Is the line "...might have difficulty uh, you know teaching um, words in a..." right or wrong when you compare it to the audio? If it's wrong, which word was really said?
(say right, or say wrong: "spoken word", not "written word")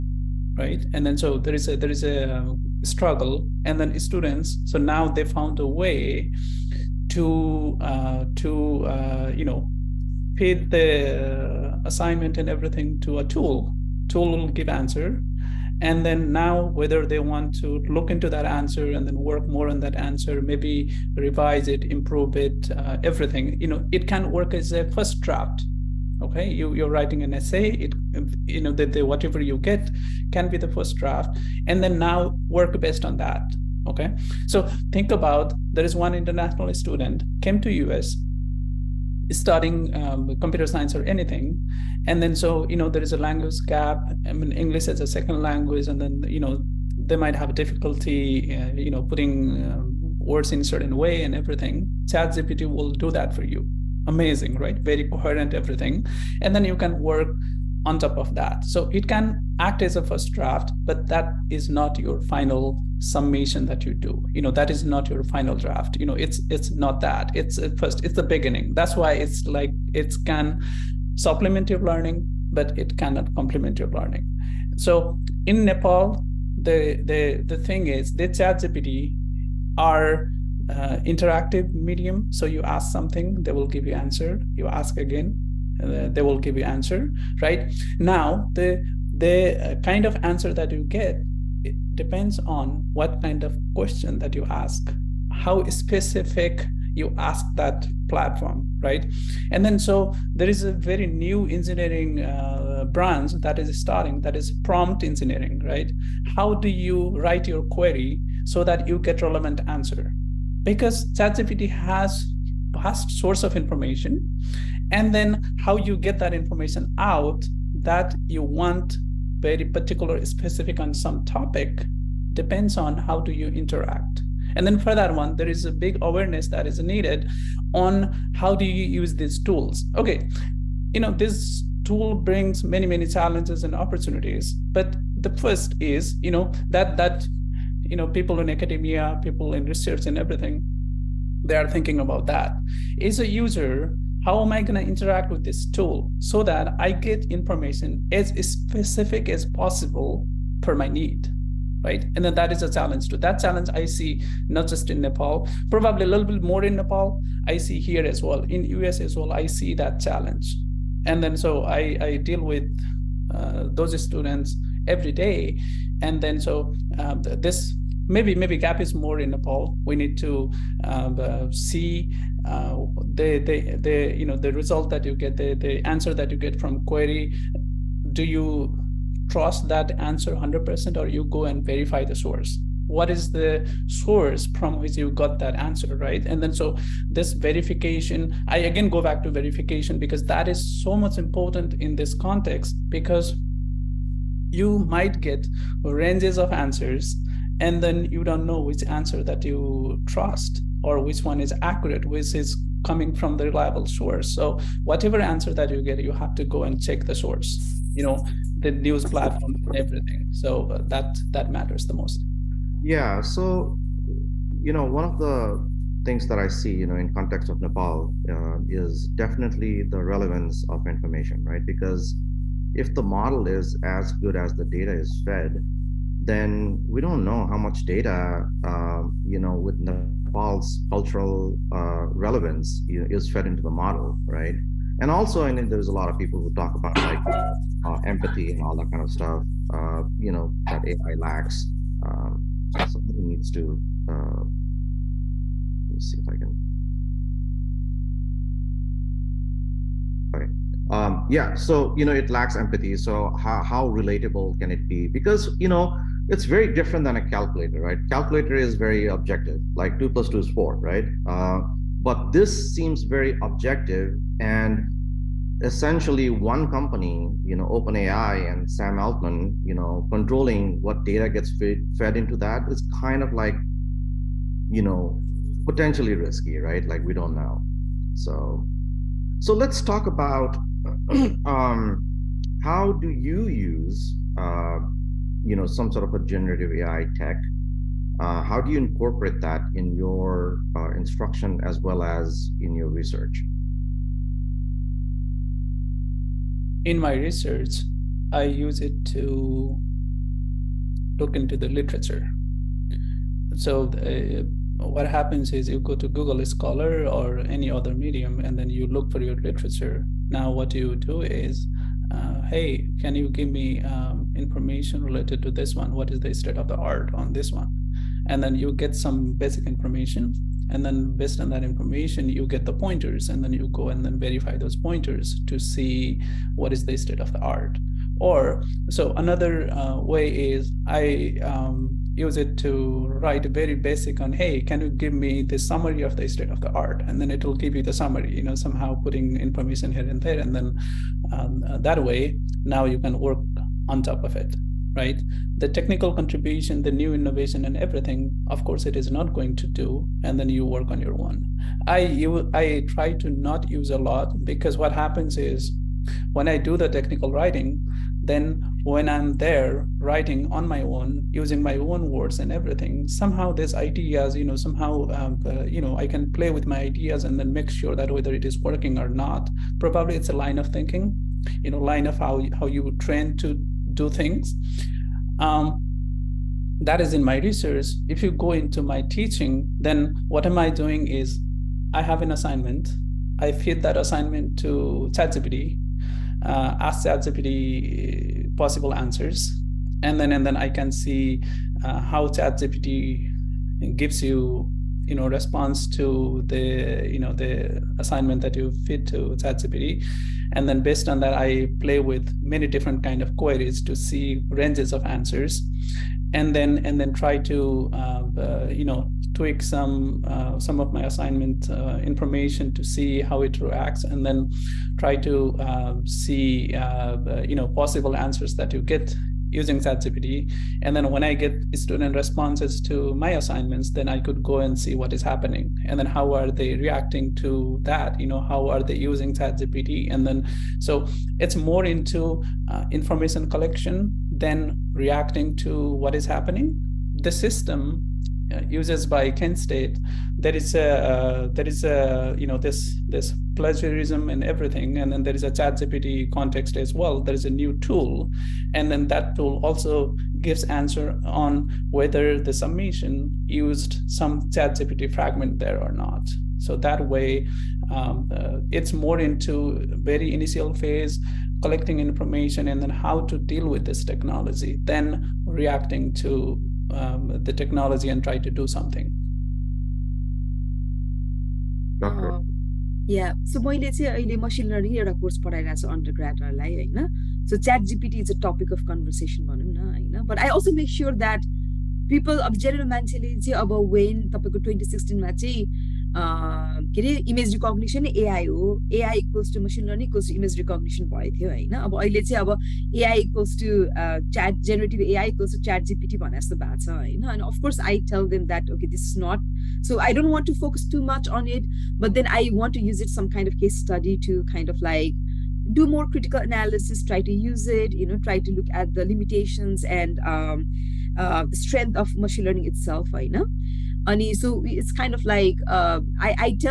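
wrong: "putting", not "teaching".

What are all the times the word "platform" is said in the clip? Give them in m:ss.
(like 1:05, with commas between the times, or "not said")
1:38, 3:29.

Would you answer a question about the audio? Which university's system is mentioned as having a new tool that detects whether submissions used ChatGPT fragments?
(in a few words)
Kent State.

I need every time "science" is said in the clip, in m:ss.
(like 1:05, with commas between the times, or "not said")
0:40.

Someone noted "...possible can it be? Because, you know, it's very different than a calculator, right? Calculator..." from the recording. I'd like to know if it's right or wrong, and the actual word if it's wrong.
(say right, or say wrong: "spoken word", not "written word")
wrong: "relatable", not "possible".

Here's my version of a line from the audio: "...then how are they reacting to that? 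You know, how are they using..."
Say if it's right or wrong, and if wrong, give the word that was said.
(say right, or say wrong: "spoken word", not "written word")
right.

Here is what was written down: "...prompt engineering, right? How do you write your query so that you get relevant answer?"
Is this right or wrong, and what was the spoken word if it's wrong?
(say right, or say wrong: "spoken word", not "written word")
right.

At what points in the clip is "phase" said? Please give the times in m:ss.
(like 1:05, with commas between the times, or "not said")
7:40.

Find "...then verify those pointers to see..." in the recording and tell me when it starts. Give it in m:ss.
5:24.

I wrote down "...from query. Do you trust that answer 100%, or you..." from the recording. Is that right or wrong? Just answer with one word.
right.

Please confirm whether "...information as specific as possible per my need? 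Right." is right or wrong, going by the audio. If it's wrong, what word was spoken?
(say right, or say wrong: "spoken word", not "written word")
right.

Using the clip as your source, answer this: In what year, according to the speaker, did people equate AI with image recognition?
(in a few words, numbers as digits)
2016.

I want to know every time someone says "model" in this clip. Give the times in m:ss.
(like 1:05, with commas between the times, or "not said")
3:43, 3:53.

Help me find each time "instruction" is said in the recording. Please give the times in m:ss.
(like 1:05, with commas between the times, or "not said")
4:50.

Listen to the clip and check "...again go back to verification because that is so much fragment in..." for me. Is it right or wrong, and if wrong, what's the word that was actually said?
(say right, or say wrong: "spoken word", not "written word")
wrong: "important", not "fragment".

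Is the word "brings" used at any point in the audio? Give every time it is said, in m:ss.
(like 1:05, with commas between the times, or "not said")
2:12.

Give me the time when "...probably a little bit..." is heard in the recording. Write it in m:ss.
2:35.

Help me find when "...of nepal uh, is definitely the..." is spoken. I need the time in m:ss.
3:37.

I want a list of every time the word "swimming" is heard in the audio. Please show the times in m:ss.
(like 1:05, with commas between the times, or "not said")
not said.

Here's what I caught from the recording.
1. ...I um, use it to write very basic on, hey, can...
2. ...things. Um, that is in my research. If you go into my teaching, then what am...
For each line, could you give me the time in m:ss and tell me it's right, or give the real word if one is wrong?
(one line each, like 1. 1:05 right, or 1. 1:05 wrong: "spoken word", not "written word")
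1. 5:30 right
2. 6:14 right.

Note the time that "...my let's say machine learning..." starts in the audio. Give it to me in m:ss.
7:53.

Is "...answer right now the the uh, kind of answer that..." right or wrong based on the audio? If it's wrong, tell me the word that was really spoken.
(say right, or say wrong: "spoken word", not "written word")
right.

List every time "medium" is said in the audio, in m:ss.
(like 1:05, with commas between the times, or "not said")
1:21, 5:07.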